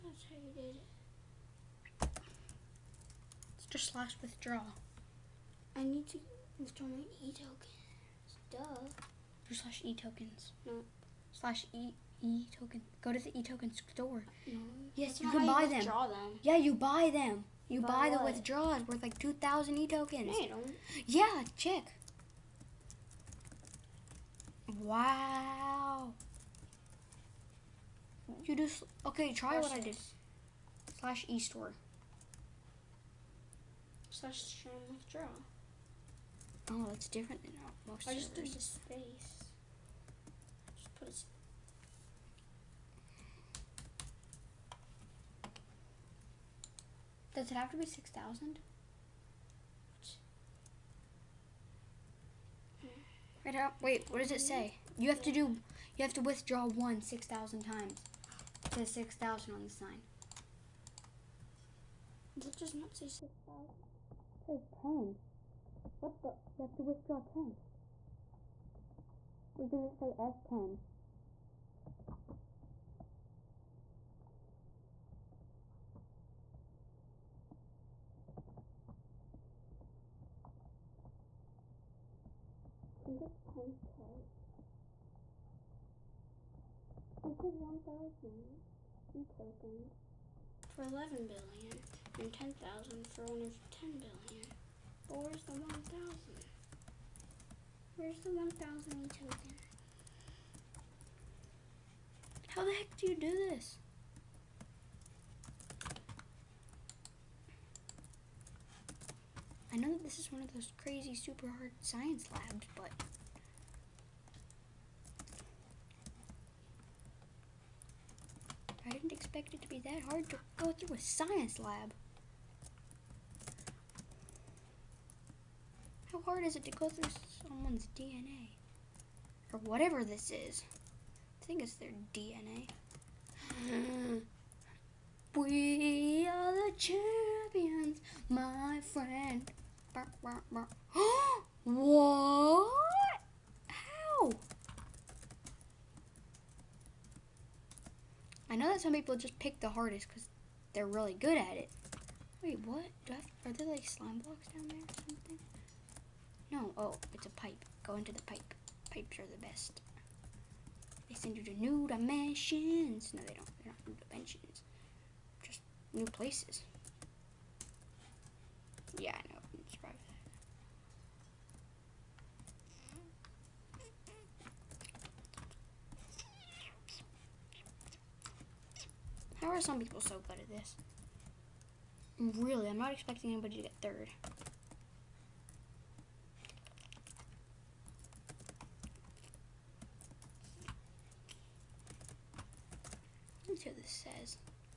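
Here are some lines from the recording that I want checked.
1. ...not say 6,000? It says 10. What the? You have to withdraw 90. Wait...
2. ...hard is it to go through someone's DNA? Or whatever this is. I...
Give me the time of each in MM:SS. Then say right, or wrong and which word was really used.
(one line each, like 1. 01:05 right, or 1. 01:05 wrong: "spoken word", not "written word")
1. 01:02 wrong: "10", not "90"
2. 02:06 right.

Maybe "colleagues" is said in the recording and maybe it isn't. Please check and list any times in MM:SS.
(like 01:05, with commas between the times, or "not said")
not said.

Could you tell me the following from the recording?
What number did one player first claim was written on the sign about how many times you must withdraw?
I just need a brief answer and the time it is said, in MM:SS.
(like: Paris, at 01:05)
6,000, at 00:58.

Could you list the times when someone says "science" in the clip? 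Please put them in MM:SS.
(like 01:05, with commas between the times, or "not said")
01:51, 02:00.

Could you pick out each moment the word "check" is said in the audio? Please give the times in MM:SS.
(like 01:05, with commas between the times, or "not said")
00:21.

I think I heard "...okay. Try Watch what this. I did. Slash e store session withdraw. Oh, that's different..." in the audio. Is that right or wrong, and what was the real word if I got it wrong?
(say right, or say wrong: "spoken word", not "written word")
right.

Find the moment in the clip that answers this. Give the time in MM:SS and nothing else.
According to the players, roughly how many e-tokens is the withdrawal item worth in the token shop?
00:19.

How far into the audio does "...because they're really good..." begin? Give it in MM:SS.
02:30.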